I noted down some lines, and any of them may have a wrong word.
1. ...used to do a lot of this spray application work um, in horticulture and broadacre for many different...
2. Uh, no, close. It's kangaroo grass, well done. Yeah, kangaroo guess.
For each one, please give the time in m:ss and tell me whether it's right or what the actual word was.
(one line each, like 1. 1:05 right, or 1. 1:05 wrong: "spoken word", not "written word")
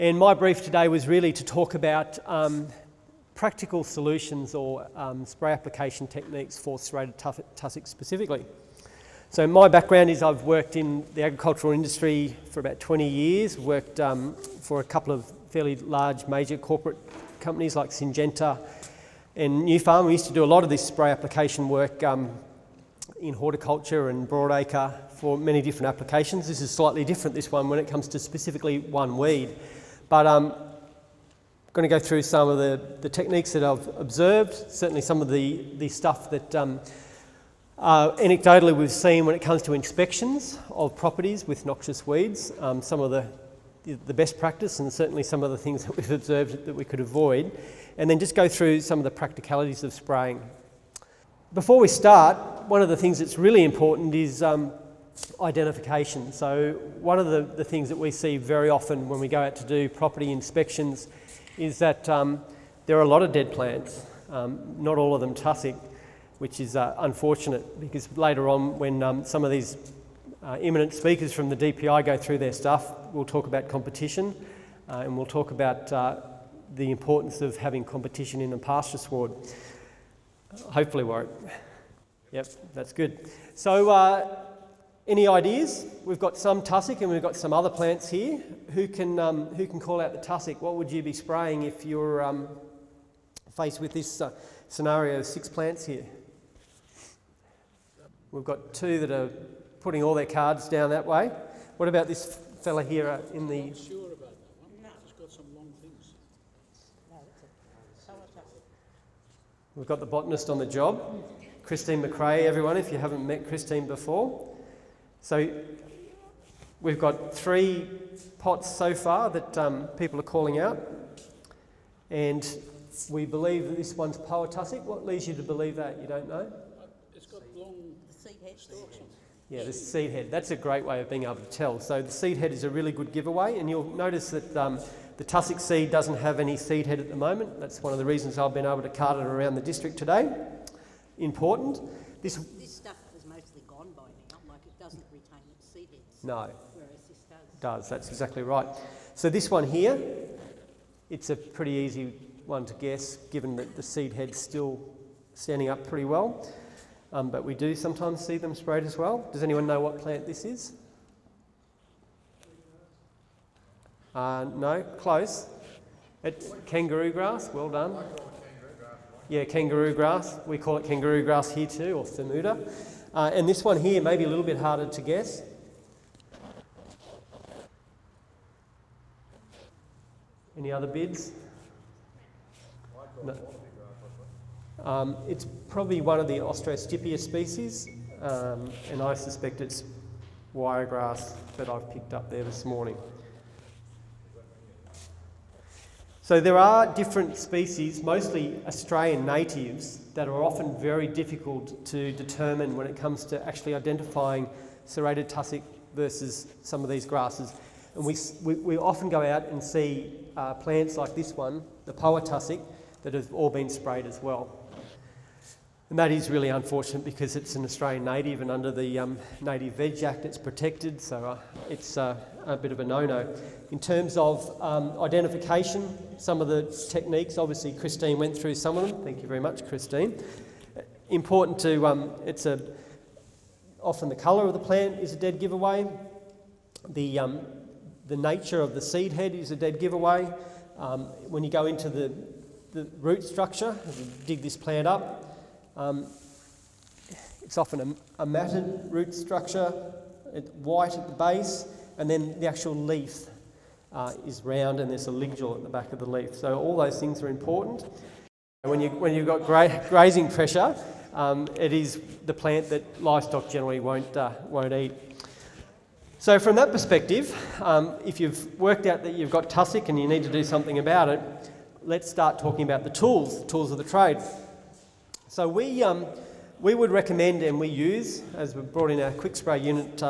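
1. 0:20 right
2. 2:44 wrong: "grass", not "guess".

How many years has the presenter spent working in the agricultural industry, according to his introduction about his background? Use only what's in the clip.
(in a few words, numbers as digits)
20.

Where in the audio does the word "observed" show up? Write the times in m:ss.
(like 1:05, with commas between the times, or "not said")
0:33, 0:46.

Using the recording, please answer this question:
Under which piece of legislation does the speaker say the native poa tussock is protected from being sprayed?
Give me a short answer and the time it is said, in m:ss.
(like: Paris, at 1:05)
Native Veg Act, at 3:39.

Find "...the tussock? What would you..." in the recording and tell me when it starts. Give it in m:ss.
1:30.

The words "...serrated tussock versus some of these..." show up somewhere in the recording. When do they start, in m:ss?
3:24.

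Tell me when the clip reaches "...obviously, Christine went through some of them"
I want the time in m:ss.
3:47.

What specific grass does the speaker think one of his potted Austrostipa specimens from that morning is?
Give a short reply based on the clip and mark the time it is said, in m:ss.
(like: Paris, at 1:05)
wiregrass, at 3:10.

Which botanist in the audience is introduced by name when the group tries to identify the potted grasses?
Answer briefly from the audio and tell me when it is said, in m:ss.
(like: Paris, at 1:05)
Christine McRae, at 1:51.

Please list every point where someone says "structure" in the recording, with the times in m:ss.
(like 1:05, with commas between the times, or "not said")
4:03, 4:09.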